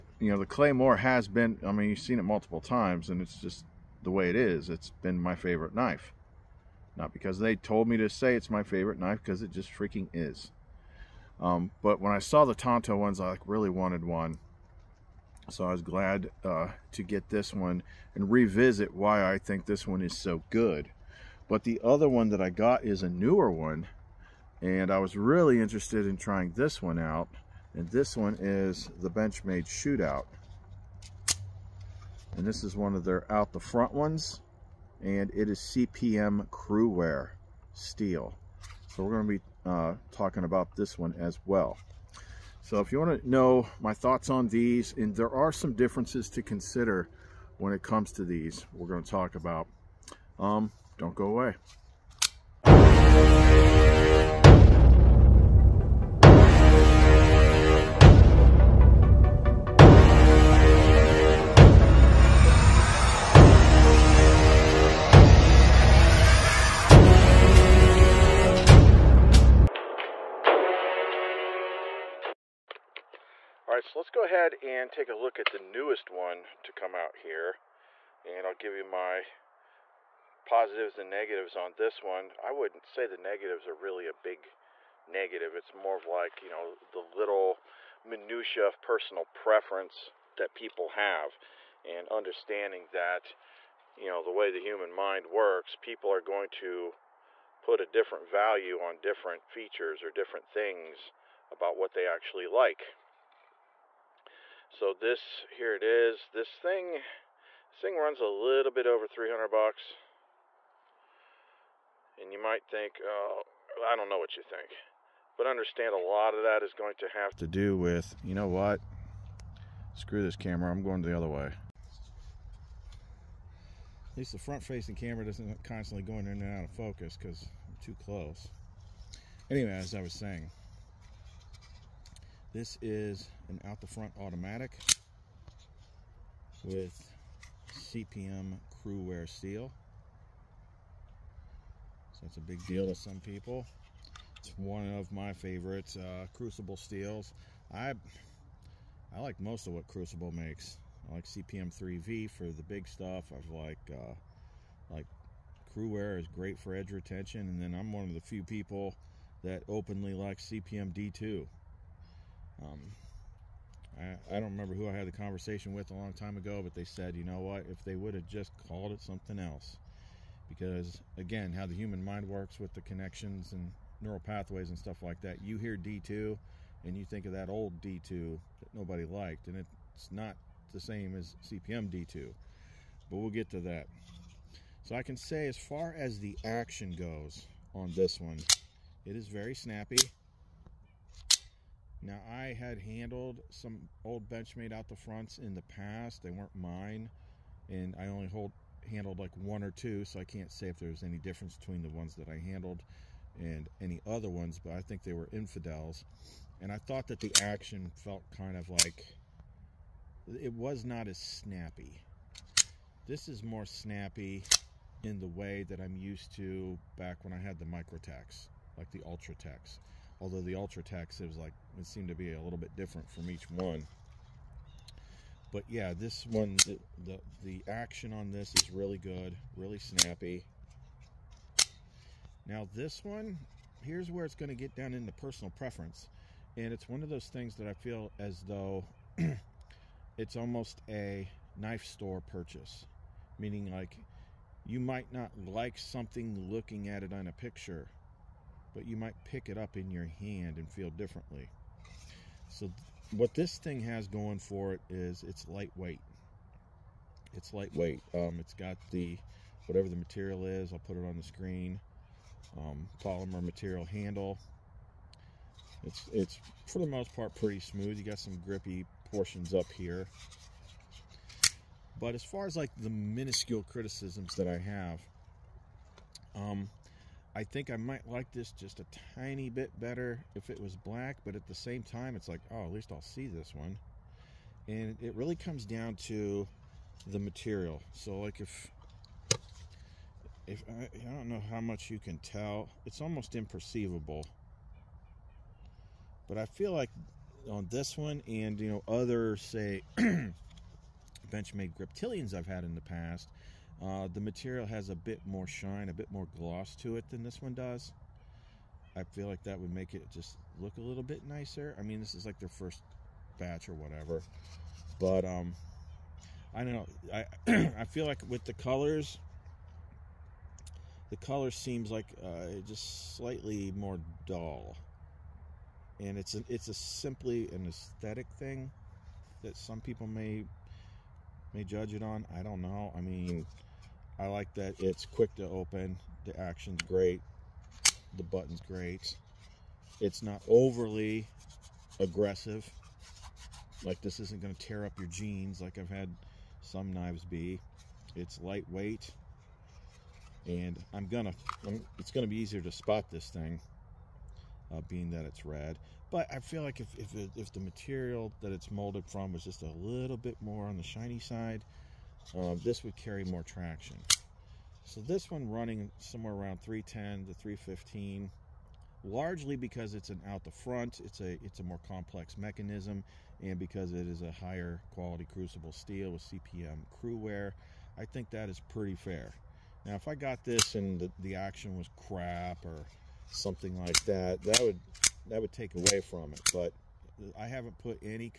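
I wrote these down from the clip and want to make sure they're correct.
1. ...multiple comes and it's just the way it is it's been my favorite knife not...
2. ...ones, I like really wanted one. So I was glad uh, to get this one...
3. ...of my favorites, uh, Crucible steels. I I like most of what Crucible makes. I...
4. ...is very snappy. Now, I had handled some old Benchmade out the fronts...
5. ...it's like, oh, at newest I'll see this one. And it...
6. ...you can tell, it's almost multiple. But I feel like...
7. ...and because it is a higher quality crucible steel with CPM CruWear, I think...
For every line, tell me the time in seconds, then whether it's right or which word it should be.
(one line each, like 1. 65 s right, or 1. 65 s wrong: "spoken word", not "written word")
1. 2 s wrong: "times", not "comes"
2. 12 s right
3. 144 s right
4. 189 s right
5. 282 s wrong: "least", not "newest"
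6. 291 s wrong: "imperceivable", not "multiple"
7. 373 s right.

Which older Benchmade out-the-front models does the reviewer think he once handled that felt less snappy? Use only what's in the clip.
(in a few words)
Infidels.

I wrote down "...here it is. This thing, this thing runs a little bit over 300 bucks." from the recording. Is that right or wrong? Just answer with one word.
right.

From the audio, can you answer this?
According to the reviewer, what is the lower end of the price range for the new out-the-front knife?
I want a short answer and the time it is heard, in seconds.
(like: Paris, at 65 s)
310, at 366 s.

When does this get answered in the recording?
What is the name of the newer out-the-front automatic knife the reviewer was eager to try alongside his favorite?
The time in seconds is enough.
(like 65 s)
29 s.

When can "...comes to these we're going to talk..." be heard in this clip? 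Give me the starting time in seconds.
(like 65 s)
47 s.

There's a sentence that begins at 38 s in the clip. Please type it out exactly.
So we're going to be uh, talking about this one as well.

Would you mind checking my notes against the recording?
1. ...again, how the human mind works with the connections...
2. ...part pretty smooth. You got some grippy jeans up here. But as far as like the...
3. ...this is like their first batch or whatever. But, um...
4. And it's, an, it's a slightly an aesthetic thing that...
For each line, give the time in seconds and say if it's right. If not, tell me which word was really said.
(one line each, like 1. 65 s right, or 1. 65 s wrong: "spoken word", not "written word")
1. 171 s right
2. 267 s wrong: "portions", not "jeans"
3. 312 s right
4. 326 s wrong: "simply", not "slightly".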